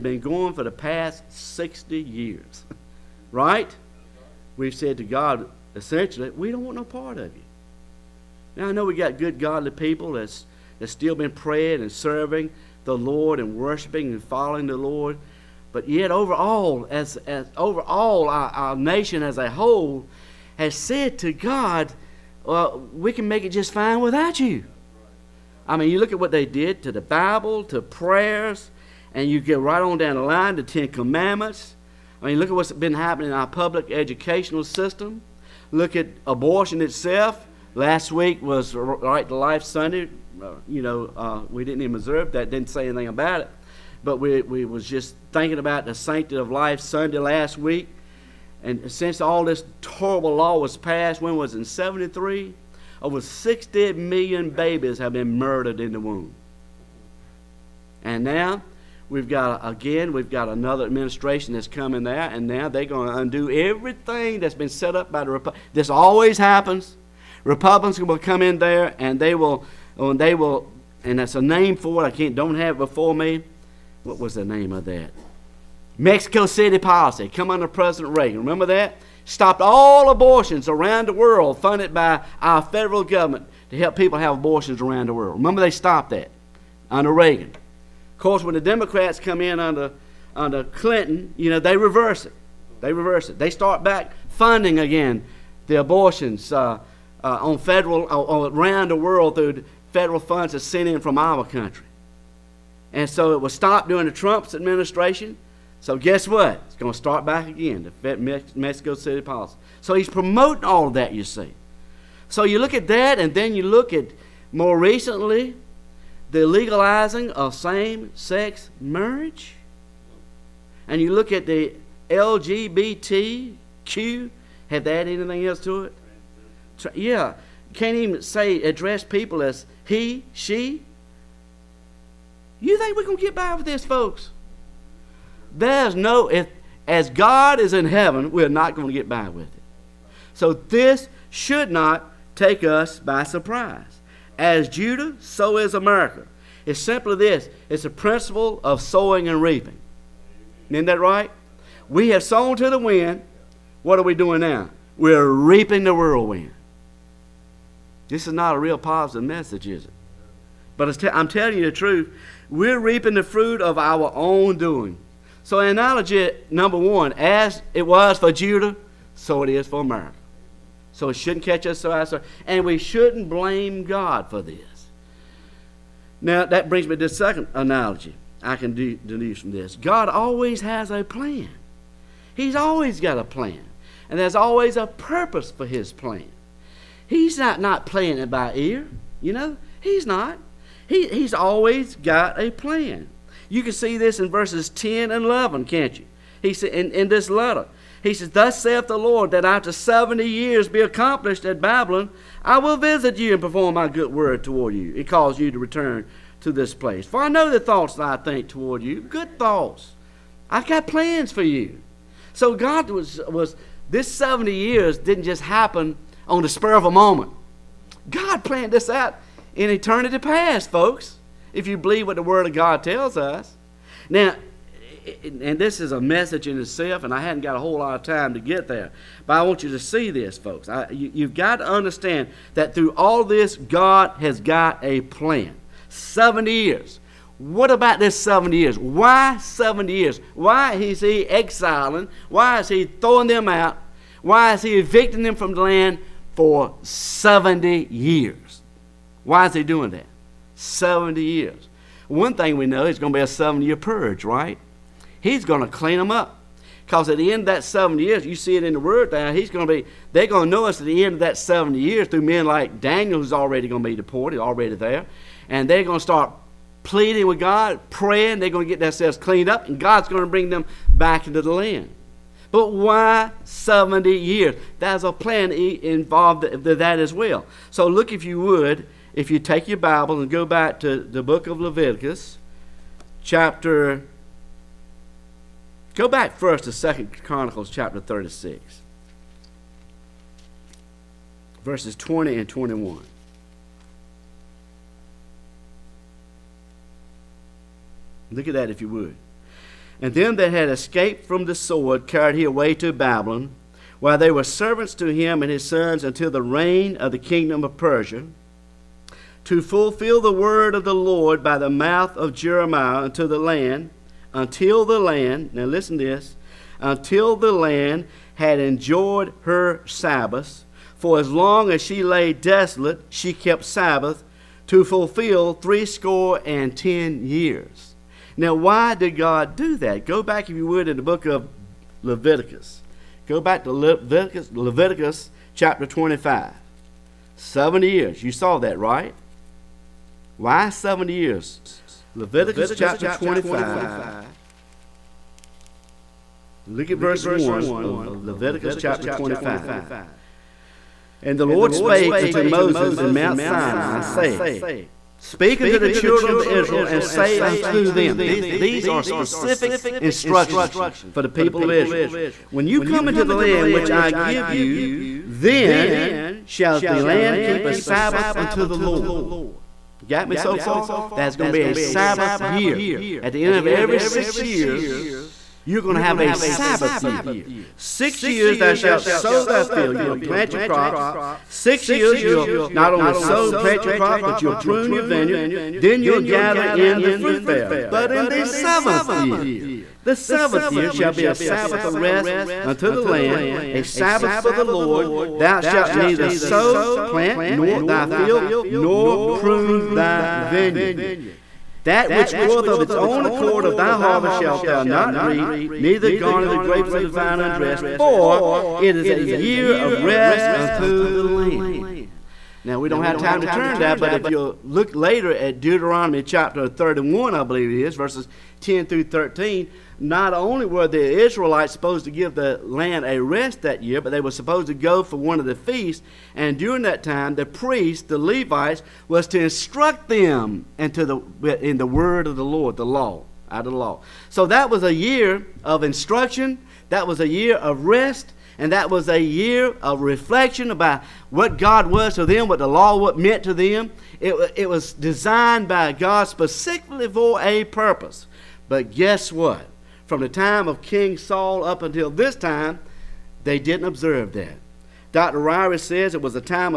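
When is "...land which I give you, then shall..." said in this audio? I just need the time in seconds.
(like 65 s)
363 s.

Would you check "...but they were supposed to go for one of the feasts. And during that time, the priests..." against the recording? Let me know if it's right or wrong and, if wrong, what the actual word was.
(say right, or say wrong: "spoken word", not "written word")
right.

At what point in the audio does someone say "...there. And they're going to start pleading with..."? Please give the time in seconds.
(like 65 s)
264 s.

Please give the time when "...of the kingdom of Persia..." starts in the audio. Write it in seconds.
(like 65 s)
306 s.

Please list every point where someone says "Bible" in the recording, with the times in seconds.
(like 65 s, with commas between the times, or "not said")
27 s, 279 s.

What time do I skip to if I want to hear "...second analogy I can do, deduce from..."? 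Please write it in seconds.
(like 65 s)
177 s.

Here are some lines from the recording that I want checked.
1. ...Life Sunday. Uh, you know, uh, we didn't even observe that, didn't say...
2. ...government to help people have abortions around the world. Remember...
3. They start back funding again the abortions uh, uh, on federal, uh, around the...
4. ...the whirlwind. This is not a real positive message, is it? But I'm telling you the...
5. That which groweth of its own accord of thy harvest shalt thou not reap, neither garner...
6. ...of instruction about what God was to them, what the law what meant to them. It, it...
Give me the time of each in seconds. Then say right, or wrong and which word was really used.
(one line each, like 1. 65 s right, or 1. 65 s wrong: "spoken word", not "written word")
1. 39 s right
2. 83 s right
3. 93 s right
4. 155 s right
5. 401 s right
6. 439 s wrong: "reflection", not "instruction".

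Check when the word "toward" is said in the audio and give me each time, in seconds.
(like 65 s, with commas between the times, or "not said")
204 s, 208 s.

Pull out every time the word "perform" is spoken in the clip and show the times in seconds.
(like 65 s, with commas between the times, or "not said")
203 s.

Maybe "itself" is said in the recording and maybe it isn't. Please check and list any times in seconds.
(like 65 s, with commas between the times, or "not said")
36 s, 226 s.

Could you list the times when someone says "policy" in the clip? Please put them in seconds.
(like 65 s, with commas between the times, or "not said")
76 s, 109 s.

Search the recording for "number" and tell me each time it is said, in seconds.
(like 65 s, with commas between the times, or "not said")
166 s.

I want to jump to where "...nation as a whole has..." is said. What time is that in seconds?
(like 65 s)
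18 s.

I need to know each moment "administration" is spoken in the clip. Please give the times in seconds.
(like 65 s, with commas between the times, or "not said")
60 s, 104 s.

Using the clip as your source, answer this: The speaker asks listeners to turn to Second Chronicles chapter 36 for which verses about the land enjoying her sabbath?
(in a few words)
20 and 21.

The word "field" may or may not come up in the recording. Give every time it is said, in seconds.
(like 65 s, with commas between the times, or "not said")
379 s, 398 s.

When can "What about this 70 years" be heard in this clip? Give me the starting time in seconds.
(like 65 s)
237 s.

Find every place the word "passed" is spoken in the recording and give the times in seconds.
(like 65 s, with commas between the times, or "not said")
50 s.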